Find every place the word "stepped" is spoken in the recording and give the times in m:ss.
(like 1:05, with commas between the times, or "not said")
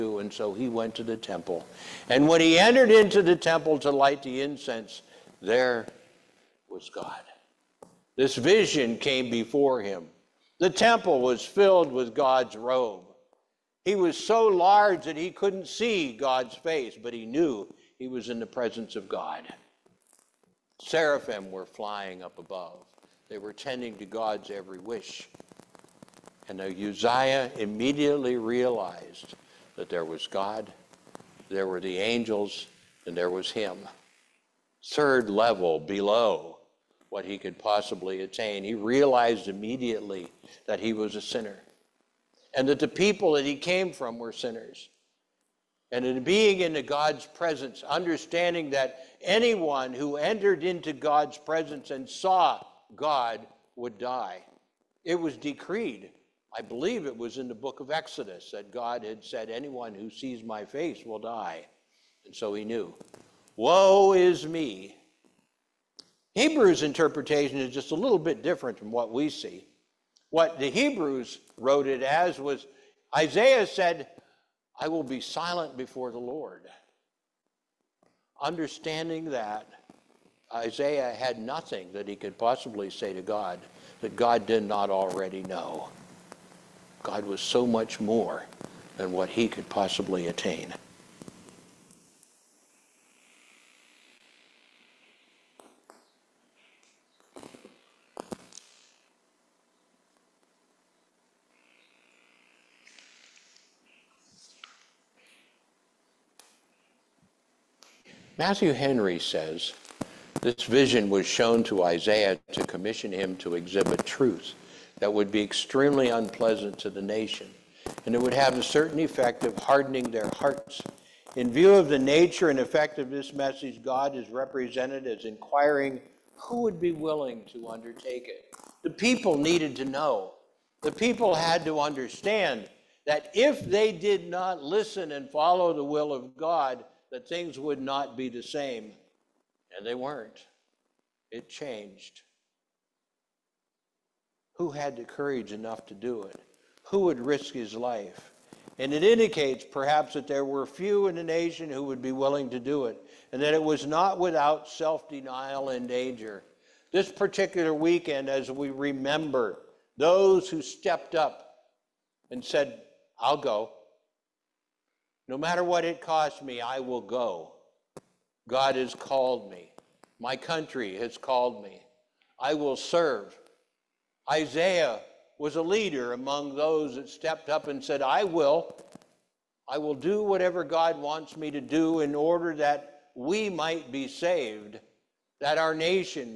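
2:40, 2:57.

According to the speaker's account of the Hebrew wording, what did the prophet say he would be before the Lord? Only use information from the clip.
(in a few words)
Silent.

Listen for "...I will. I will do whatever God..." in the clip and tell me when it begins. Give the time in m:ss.
2:58.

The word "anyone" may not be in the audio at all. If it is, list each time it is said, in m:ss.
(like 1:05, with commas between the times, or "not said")
0:49, 0:59.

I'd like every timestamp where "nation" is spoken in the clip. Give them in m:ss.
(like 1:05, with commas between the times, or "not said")
1:57, 2:31, 3:05.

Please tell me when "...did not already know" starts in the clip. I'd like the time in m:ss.
1:24.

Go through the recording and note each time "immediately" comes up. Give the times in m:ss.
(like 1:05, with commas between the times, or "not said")
0:27, 0:39.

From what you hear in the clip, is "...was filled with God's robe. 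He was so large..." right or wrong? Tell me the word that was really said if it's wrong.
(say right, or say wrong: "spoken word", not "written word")
right.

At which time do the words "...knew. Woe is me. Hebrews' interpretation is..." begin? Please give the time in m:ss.
1:02.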